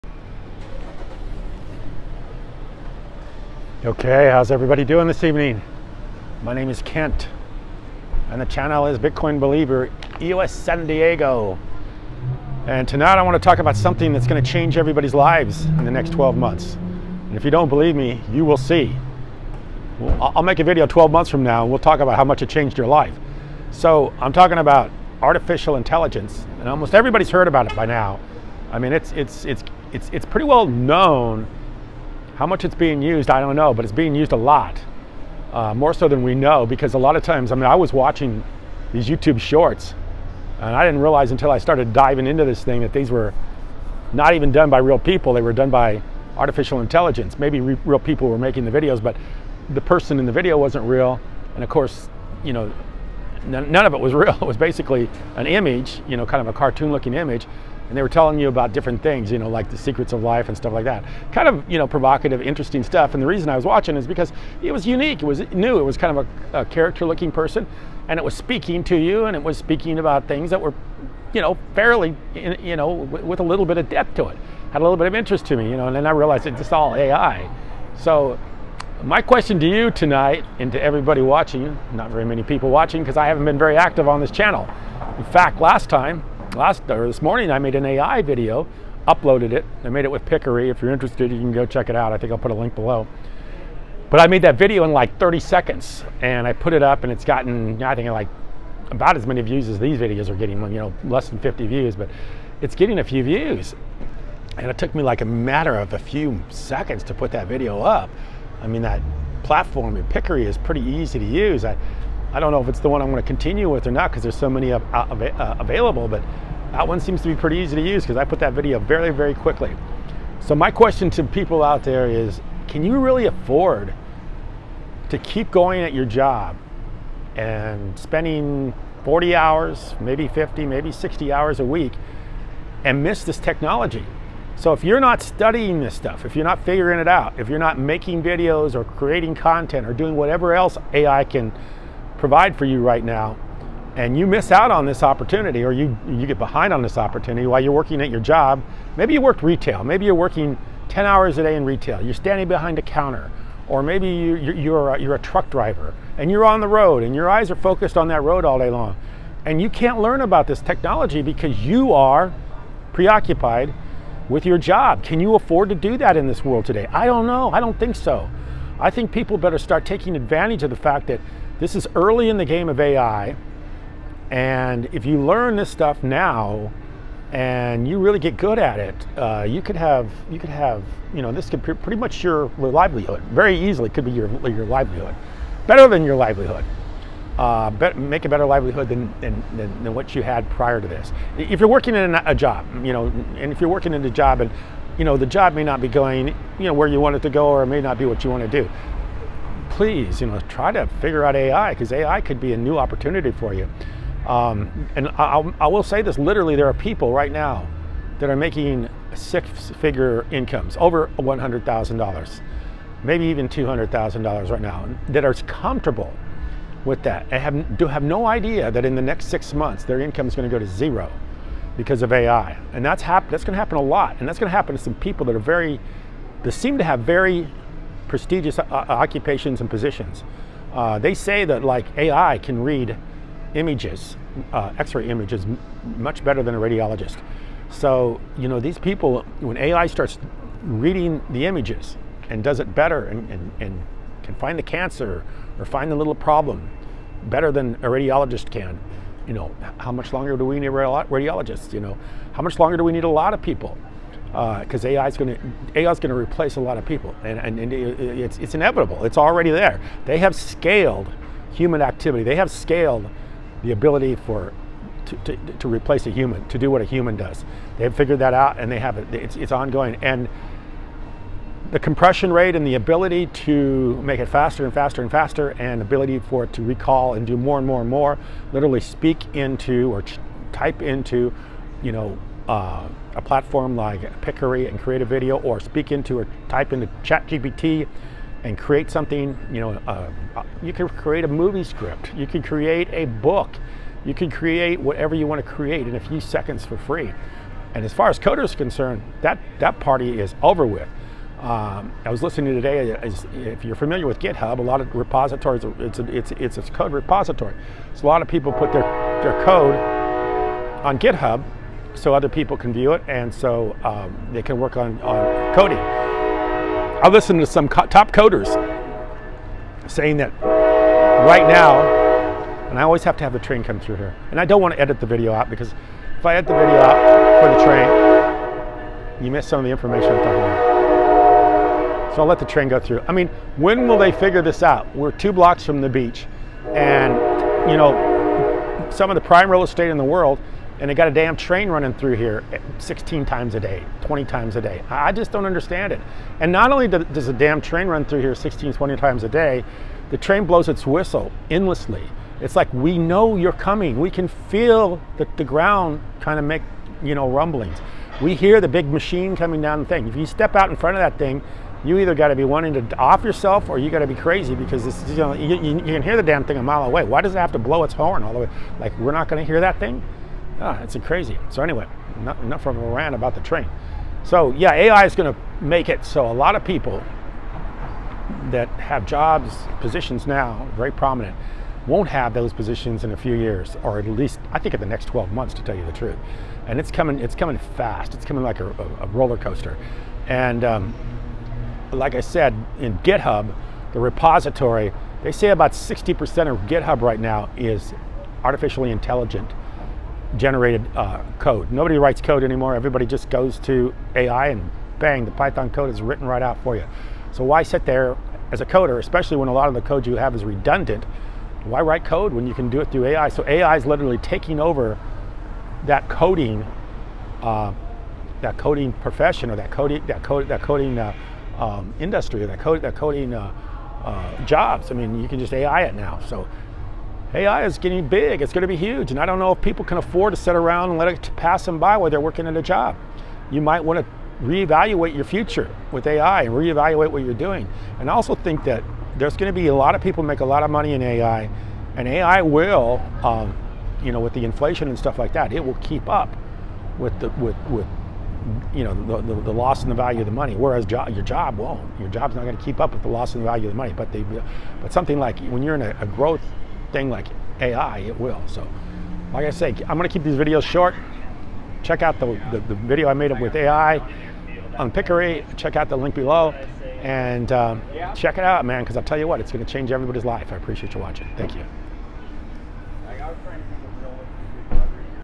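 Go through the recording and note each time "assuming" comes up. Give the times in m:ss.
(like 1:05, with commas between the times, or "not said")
not said.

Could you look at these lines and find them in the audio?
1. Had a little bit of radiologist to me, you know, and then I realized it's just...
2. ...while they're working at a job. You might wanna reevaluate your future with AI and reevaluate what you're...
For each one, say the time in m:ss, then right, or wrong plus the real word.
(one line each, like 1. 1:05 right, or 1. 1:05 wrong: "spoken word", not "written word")
1. 1:14 wrong: "interest", not "radiologist"
2. 7:11 right.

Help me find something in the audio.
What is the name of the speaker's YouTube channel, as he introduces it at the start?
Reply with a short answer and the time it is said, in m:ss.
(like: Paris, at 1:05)
Bitcoin Believer EOS San Diego, at 0:08.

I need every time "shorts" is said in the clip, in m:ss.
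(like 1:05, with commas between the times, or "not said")
0:39, 7:40.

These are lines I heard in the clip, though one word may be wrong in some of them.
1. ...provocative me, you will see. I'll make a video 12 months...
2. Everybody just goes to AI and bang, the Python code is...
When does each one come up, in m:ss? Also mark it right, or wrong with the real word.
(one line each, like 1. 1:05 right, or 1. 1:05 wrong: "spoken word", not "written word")
1. 0:17 wrong: "believe", not "provocative"
2. 6:42 right.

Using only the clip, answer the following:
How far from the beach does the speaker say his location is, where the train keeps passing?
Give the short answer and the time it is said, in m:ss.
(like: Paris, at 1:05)
2 blocks, at 5:35.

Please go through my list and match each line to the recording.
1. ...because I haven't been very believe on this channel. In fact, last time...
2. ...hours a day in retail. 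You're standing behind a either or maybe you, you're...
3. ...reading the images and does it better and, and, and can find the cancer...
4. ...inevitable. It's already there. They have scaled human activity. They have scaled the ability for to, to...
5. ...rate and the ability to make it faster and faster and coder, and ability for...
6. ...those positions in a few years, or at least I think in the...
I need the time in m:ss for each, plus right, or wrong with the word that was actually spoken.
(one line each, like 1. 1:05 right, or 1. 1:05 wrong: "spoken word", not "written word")
1. 1:23 wrong: "active", not "believe"
2. 2:31 wrong: "counter", not "either"
3. 4:00 right
4. 4:18 right
5. 4:32 wrong: "faster", not "coder"
6. 6:22 right.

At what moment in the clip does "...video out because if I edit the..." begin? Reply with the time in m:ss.
5:25.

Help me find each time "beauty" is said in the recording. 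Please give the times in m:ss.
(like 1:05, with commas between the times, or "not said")
not said.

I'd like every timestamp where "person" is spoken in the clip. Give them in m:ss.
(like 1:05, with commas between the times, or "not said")
0:49, 1:07.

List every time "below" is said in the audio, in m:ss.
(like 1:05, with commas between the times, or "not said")
1:32, 7:46.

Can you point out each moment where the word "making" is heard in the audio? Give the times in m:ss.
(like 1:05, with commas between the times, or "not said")
0:48, 2:17, 3:28.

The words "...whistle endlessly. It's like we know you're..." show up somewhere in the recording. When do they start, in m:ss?
5:50.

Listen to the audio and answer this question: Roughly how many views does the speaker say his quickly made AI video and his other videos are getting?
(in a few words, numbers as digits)
less than 50.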